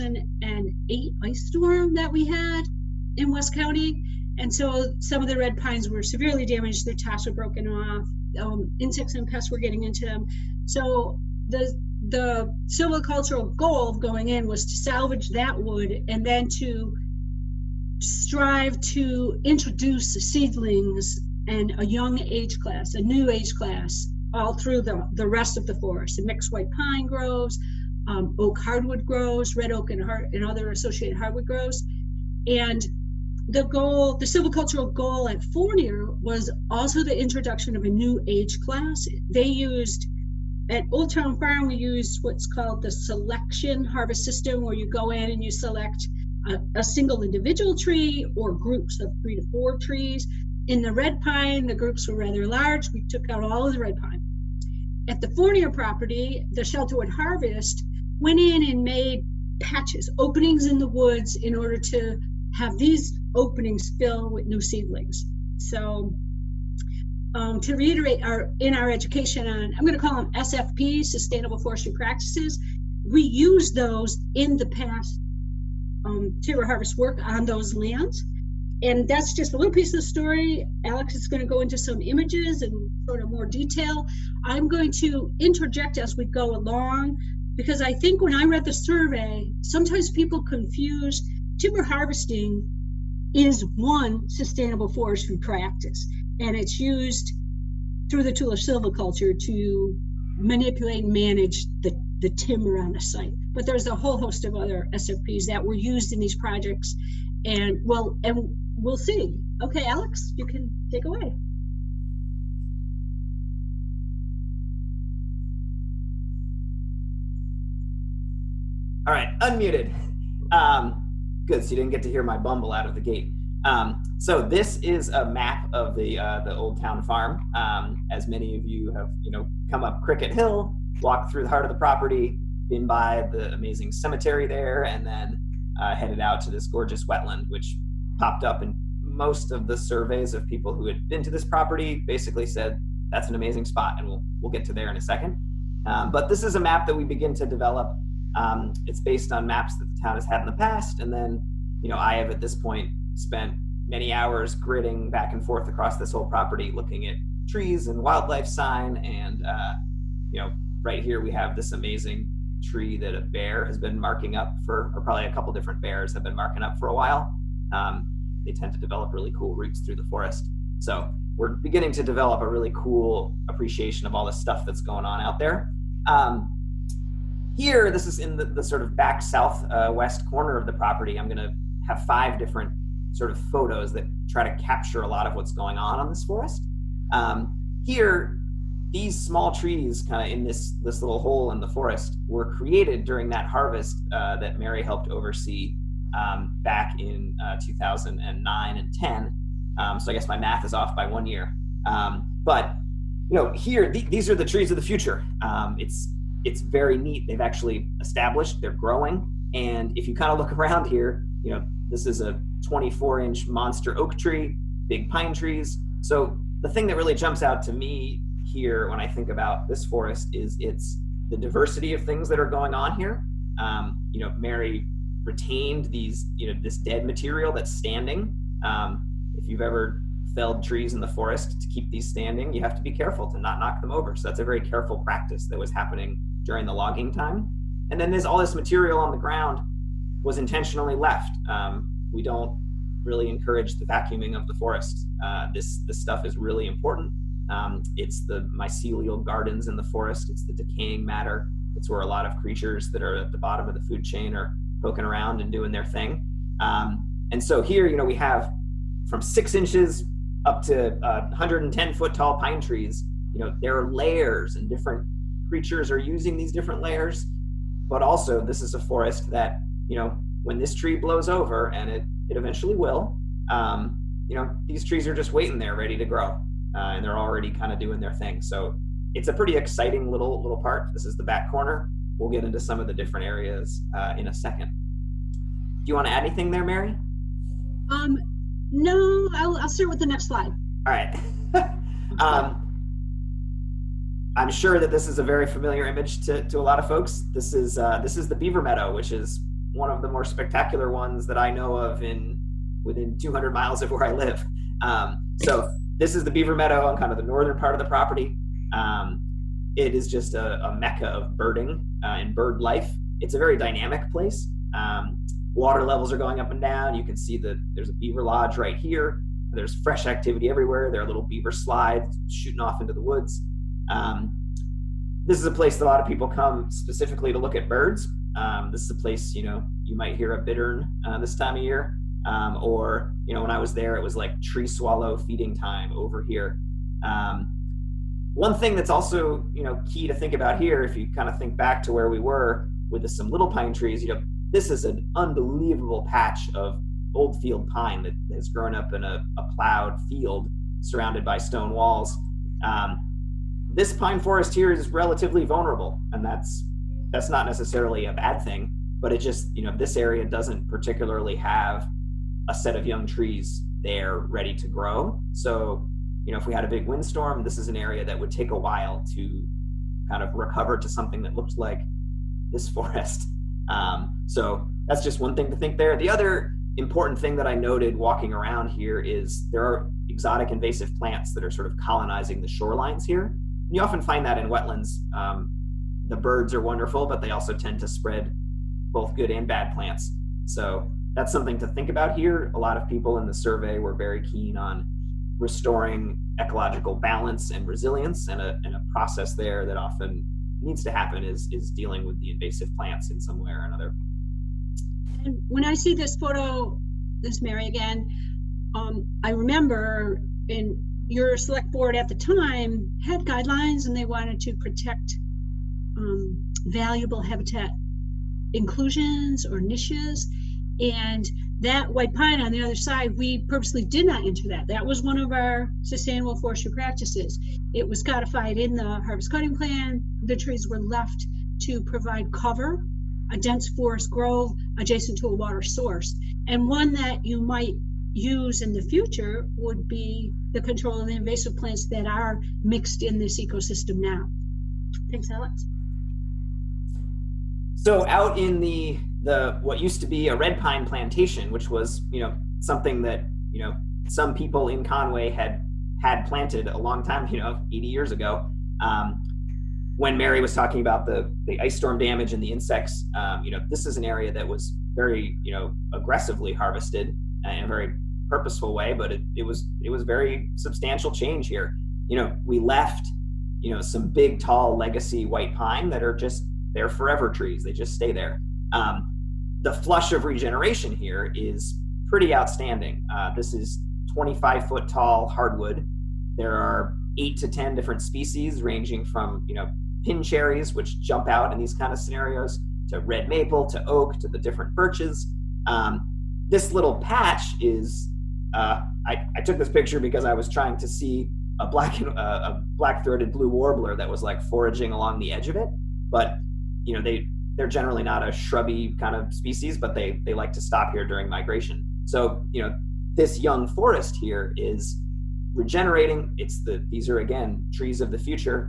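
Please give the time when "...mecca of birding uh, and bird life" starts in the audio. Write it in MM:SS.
05:10.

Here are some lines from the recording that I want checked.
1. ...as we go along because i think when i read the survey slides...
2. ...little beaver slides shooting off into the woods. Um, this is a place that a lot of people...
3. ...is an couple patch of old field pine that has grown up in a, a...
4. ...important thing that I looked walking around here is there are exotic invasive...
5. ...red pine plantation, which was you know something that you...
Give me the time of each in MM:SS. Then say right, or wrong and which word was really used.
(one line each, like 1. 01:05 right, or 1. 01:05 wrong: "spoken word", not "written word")
1. 01:25 wrong: "sometimes", not "slides"
2. 05:21 right
3. 05:44 wrong: "unbelievable", not "couple"
4. 06:16 wrong: "noted", not "looked"
5. 07:30 right.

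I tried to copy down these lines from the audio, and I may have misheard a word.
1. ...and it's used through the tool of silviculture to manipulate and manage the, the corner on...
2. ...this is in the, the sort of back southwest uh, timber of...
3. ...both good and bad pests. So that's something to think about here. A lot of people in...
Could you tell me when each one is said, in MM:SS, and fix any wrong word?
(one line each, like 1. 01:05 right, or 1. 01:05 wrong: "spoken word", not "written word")
1. 01:36 wrong: "timber", not "corner"
2. 02:57 wrong: "corner", not "timber"
3. 06:28 wrong: "plants", not "pests".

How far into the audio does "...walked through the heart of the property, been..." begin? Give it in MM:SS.
02:11.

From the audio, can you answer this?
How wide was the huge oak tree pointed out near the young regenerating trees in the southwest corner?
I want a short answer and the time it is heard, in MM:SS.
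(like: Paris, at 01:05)
24 inches, at 03:32.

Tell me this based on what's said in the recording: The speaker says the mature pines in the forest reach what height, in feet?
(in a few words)
110 feet.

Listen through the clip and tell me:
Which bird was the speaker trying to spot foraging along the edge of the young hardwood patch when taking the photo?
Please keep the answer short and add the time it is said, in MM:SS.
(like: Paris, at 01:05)
Black-throated blue warbler, at 08:22.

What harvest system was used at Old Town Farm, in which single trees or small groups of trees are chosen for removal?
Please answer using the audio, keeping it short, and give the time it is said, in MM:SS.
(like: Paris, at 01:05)
Selection harvest system, at 00:42.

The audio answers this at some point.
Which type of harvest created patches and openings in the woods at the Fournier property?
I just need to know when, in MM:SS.
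00:56.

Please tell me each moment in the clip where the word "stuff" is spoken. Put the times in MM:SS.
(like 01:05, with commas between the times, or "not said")
02:54, 04:05.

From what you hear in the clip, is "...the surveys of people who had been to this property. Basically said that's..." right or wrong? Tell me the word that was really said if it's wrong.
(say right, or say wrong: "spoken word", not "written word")
right.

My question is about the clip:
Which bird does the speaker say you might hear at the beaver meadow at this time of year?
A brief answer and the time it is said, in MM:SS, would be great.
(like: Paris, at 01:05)
Bittern, at 05:30.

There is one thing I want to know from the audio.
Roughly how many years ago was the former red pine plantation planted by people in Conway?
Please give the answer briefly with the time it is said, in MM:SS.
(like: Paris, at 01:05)
80 years, at 07:37.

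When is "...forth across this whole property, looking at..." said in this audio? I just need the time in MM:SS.
02:35.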